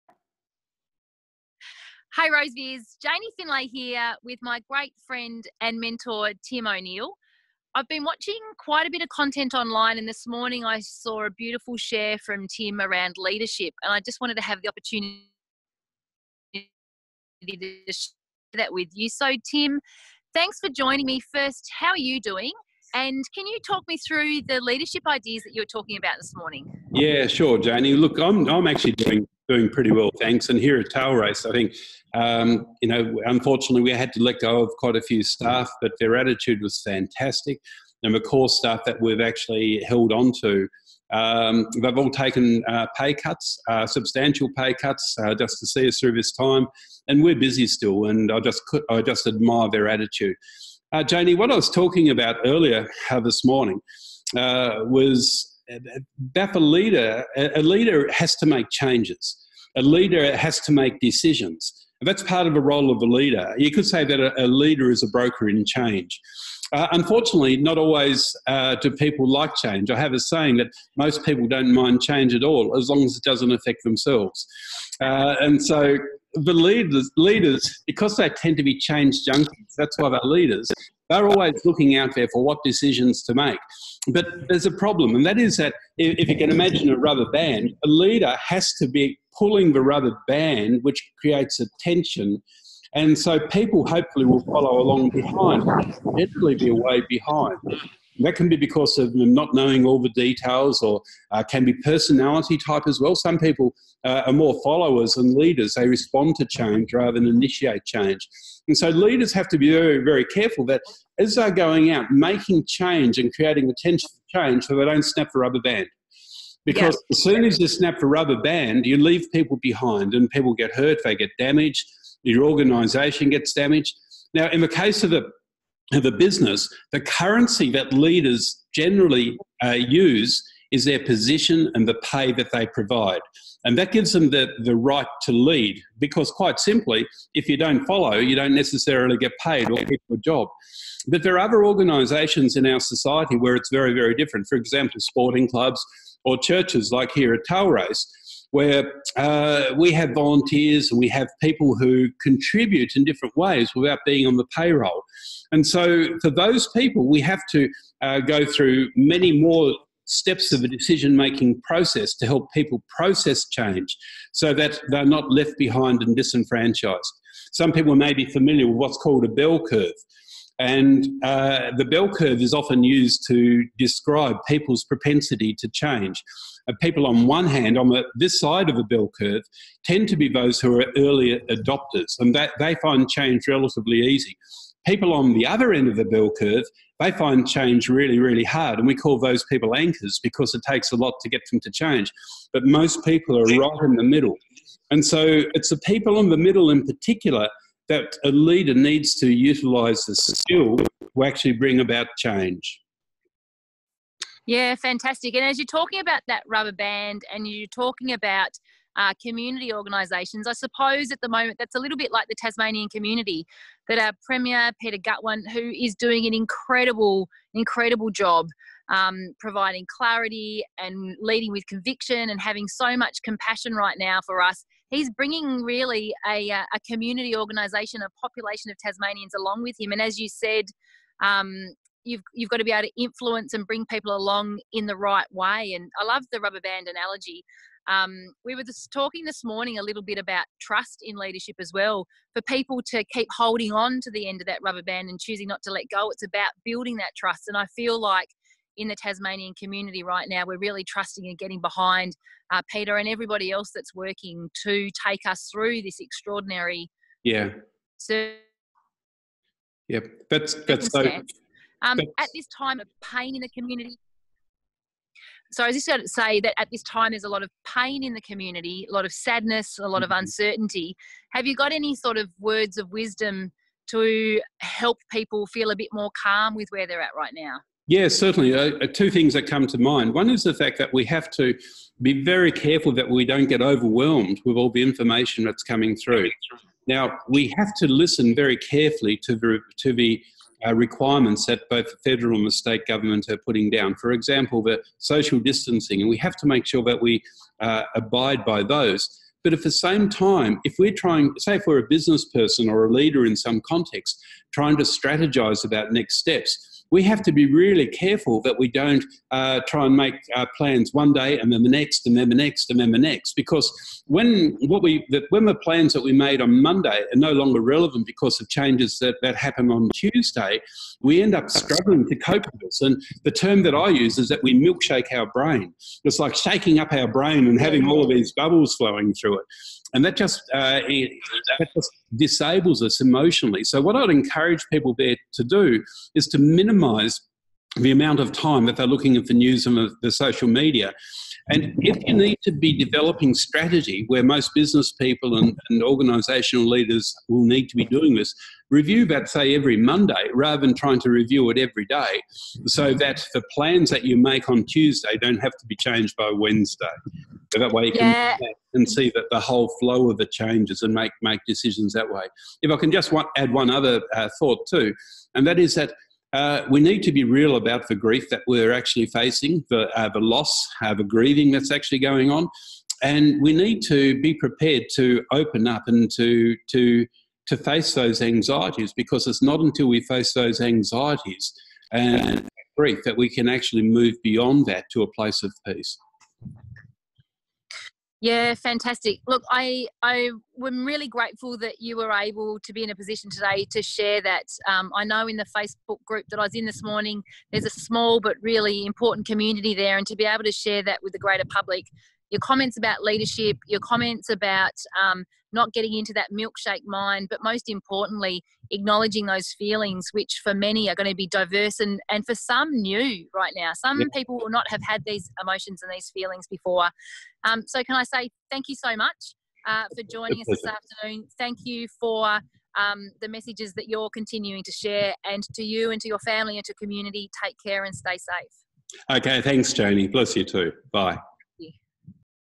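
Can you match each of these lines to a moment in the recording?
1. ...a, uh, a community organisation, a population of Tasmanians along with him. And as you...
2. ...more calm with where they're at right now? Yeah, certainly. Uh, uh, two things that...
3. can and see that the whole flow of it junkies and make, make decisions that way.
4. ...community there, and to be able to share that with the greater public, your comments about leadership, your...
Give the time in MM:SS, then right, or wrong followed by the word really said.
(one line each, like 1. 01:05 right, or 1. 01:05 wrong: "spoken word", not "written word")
1. 03:46 right
2. 04:35 right
3. 05:58 wrong: "changes", not "junkies"
4. 06:39 right.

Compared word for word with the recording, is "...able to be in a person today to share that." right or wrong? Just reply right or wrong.
wrong.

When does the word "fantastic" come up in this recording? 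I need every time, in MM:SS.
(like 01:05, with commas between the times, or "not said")
00:36, 03:24, 06:28.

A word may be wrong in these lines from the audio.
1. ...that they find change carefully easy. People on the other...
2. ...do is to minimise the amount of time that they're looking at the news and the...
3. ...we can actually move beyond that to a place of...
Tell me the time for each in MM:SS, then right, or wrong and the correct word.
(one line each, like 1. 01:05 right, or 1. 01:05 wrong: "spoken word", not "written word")
1. 03:02 wrong: "relatively", not "carefully"
2. 05:35 right
3. 06:23 right.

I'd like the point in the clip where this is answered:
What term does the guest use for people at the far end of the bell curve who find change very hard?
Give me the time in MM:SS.
03:09.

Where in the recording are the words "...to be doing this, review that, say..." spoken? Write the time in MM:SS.
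05:47.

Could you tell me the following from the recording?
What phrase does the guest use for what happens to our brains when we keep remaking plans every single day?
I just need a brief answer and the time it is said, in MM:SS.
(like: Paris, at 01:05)
Milkshake our brain, at 05:24.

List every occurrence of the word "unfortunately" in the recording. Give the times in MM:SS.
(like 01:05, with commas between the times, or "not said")
00:33, 01:06.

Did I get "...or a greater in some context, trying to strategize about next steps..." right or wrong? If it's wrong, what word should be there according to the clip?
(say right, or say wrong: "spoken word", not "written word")
wrong: "leader", not "greater".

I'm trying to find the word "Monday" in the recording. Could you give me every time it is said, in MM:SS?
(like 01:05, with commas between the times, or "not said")
05:16, 05:49.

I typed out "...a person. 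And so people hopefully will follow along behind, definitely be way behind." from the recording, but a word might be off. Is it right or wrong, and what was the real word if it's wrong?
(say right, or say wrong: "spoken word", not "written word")
wrong: "tension", not "person".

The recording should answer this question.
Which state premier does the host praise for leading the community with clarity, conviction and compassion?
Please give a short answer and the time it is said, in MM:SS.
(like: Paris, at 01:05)
Peter Gutwein, at 03:34.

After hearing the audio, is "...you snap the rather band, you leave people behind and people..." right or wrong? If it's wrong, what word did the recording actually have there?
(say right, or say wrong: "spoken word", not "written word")
wrong: "rubber", not "rather".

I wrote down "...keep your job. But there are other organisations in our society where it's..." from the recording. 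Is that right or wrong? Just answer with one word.
right.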